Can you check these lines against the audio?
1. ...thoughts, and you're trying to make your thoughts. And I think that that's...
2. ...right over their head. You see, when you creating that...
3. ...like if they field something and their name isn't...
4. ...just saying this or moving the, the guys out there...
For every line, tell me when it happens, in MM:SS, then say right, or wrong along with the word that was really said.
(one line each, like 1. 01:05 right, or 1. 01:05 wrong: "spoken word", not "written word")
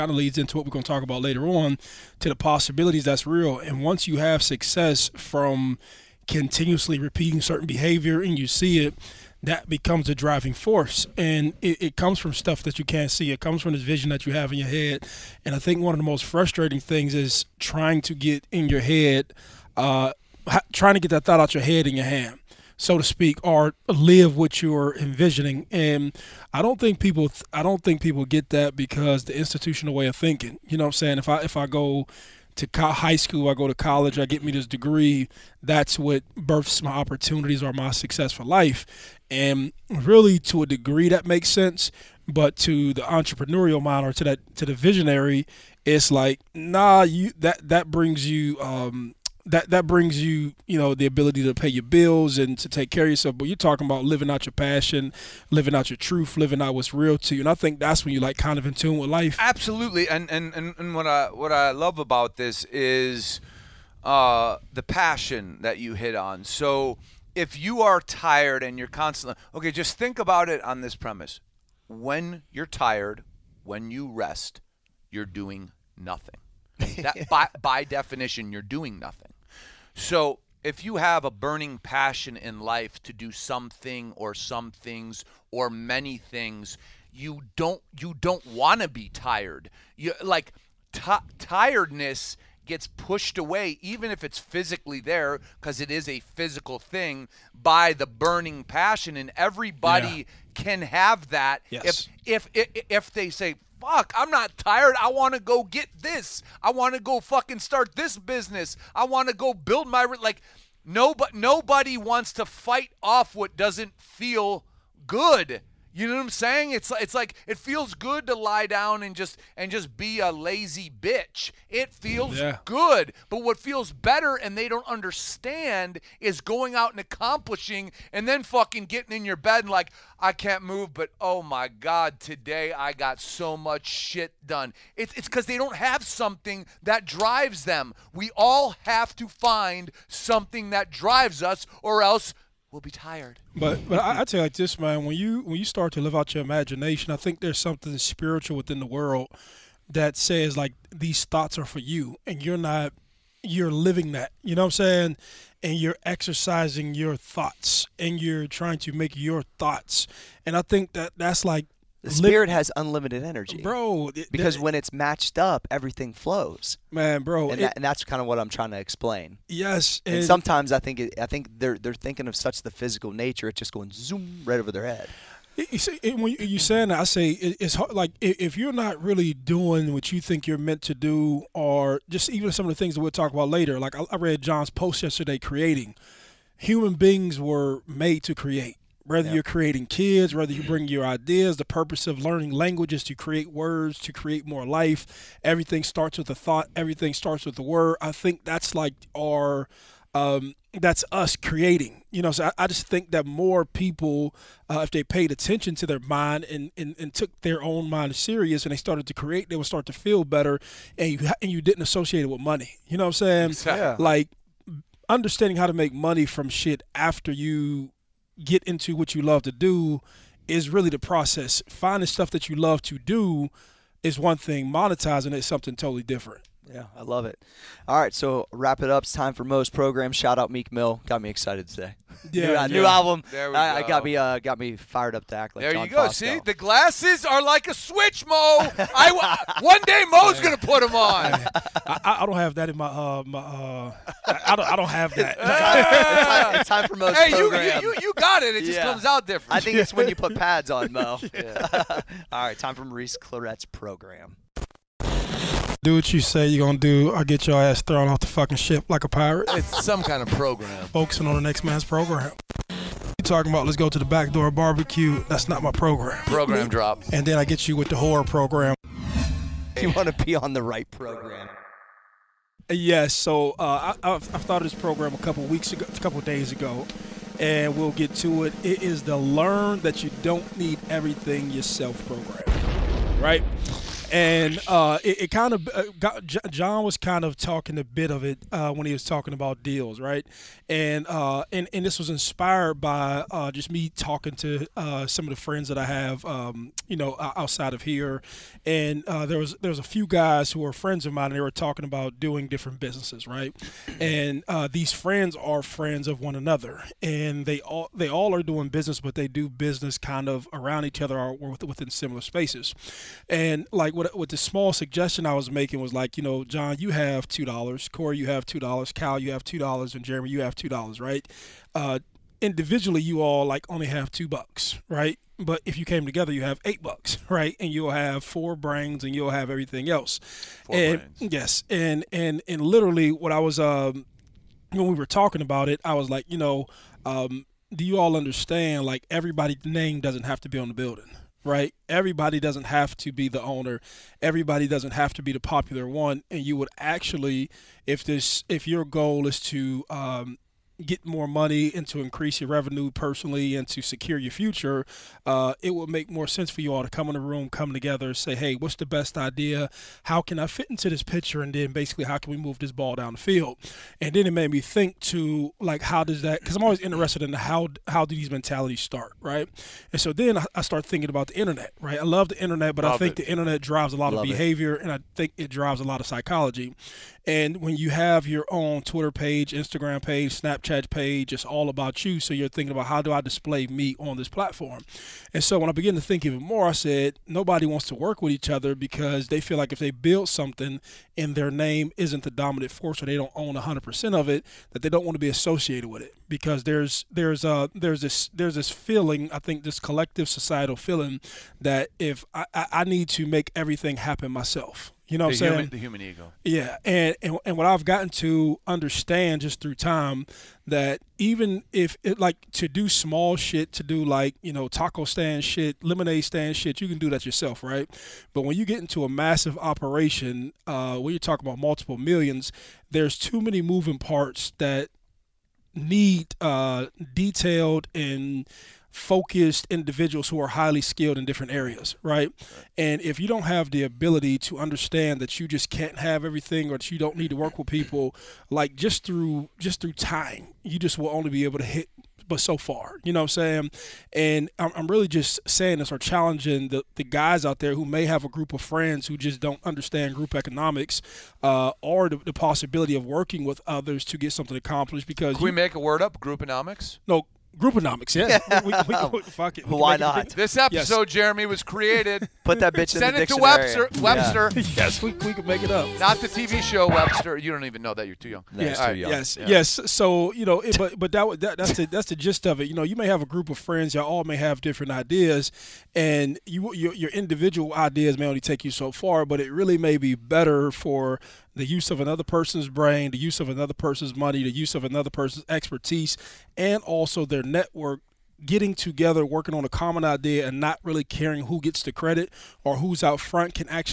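1. 02:37 right
2. 02:54 wrong: "saying", not "creating"
3. 06:29 wrong: "build", not "field"
4. 07:25 wrong: "challenging", not "moving".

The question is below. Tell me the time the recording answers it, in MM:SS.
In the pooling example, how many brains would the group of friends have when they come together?
05:28.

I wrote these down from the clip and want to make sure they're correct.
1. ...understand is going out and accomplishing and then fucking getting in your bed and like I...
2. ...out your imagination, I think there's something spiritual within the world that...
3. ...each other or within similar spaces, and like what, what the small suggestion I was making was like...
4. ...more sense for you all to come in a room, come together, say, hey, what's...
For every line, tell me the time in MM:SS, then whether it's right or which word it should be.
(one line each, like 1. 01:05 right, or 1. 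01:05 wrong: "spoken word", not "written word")
1. 02:04 right
2. 02:26 right
3. 05:10 right
4. 05:56 right.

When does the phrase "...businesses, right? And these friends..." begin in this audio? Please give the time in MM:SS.
05:02.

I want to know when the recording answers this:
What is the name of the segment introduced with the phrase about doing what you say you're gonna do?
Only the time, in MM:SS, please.
04:12.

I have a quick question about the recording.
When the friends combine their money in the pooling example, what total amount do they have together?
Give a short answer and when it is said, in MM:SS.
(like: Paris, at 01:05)
8 dollars, at 05:26.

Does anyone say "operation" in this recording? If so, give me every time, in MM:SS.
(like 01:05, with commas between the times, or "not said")
06:59.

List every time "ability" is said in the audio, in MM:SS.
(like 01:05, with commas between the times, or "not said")
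00:51, 07:13.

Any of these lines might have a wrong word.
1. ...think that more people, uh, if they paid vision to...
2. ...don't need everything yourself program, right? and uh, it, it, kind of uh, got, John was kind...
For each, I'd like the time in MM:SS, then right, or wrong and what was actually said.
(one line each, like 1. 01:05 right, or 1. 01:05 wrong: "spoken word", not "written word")
1. 03:22 wrong: "attention", not "vision"
2. 04:40 right.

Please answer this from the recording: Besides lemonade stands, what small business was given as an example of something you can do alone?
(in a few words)
Taco stand.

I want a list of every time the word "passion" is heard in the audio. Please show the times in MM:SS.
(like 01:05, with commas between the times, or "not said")
00:54, 01:04, 01:21, 01:38.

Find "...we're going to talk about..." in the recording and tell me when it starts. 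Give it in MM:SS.
00:00.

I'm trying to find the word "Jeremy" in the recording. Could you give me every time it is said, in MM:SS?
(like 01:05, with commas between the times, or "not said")
05:20, 07:41.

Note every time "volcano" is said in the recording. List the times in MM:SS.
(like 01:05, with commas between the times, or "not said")
not said.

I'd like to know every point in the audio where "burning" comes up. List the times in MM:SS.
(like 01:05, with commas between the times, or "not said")
01:21, 01:38.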